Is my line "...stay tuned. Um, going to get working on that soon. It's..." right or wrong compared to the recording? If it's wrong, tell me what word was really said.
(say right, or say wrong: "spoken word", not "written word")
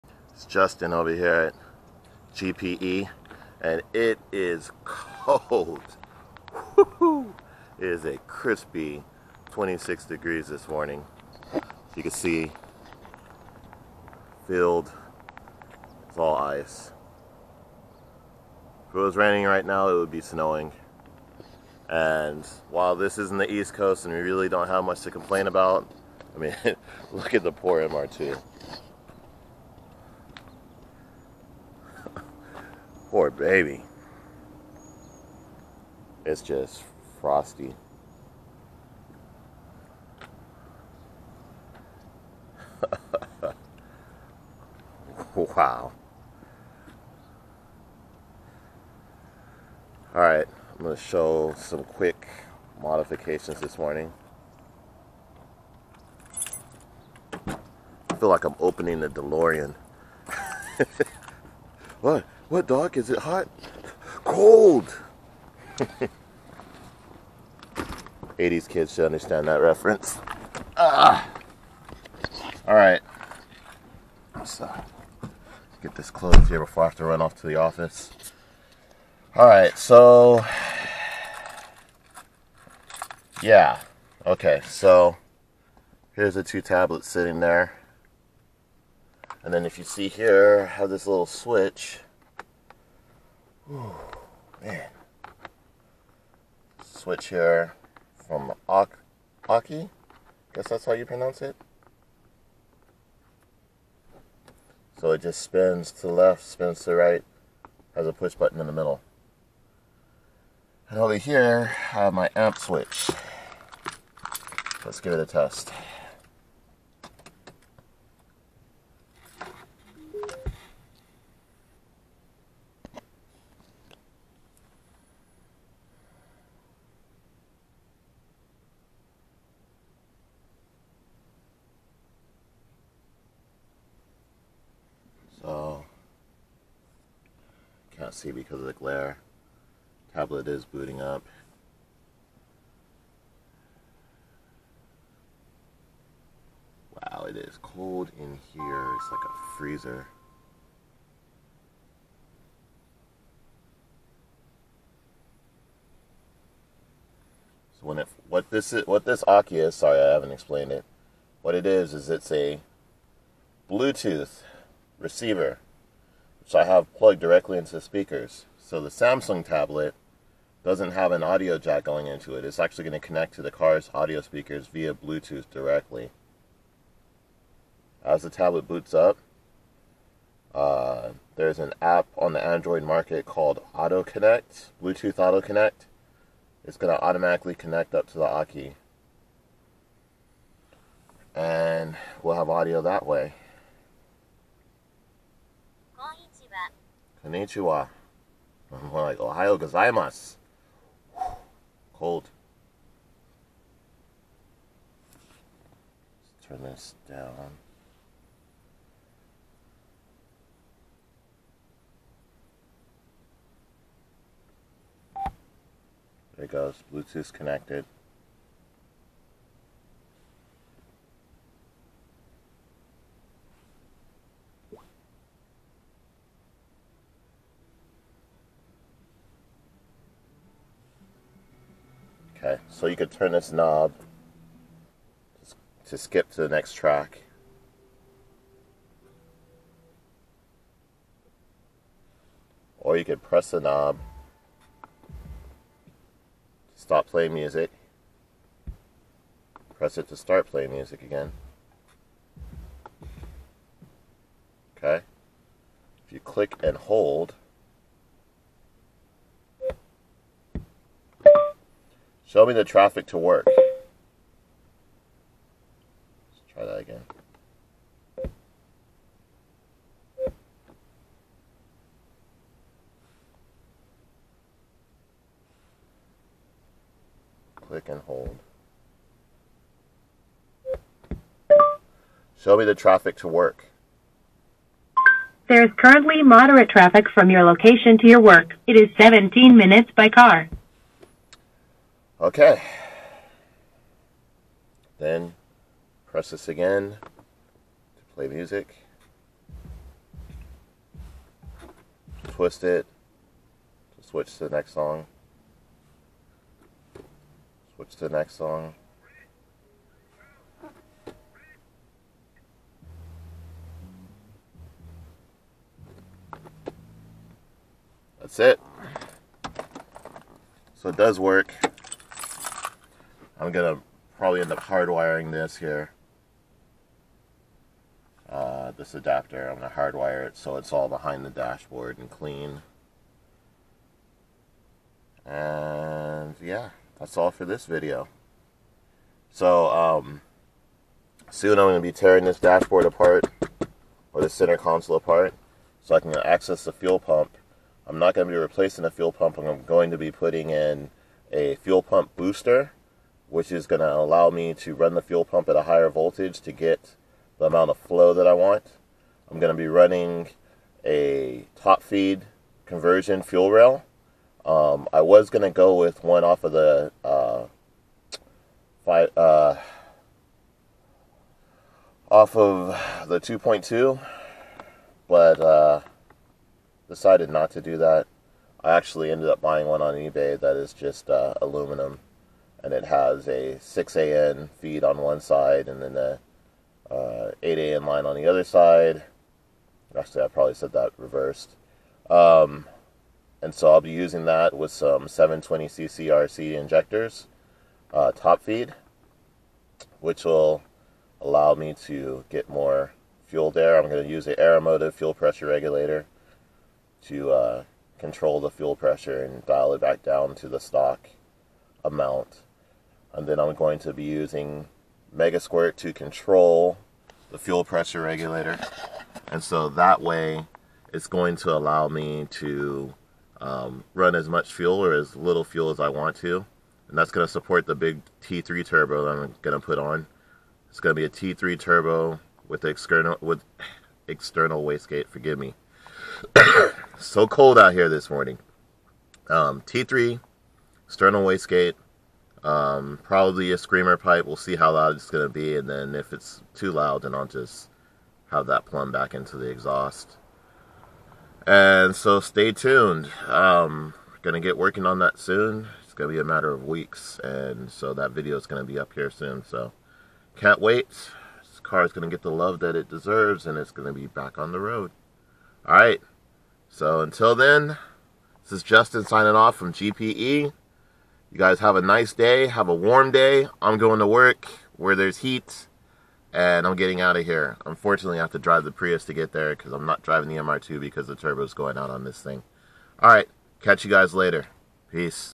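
right.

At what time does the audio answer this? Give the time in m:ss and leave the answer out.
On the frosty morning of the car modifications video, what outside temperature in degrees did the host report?
0:09.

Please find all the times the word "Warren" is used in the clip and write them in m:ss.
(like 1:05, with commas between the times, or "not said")
not said.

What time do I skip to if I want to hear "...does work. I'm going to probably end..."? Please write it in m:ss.
5:20.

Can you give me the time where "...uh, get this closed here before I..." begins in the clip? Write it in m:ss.
1:14.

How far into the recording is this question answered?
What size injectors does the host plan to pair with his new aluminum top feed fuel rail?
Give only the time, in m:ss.
6:35.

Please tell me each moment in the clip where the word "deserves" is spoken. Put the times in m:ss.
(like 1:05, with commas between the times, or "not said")
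7:42.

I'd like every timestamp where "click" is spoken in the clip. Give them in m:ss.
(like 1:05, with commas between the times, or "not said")
4:16, 4:37.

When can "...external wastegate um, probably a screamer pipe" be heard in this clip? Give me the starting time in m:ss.
7:20.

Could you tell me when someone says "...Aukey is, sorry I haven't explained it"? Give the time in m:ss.
2:39.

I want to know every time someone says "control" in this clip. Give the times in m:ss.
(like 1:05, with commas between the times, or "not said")
6:47, 6:55.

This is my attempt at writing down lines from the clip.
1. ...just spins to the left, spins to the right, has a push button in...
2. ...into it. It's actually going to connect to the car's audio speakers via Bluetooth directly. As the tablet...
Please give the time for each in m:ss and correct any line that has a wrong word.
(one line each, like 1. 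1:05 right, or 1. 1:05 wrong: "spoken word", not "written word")
1. 1:45 right
2. 2:52 right.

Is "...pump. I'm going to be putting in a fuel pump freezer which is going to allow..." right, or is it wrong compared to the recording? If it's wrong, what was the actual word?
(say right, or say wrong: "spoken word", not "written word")
wrong: "booster", not "freezer".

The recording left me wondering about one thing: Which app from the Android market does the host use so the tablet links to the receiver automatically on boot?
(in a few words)
Bluetooth Auto Connect.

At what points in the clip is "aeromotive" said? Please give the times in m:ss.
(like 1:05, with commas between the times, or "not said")
6:44.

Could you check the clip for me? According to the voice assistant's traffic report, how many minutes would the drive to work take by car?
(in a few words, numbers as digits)
17.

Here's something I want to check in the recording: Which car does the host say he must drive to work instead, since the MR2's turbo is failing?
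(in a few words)
Prius.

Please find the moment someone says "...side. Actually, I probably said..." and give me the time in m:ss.
6:28.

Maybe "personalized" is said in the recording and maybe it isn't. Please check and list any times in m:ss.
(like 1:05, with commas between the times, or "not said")
not said.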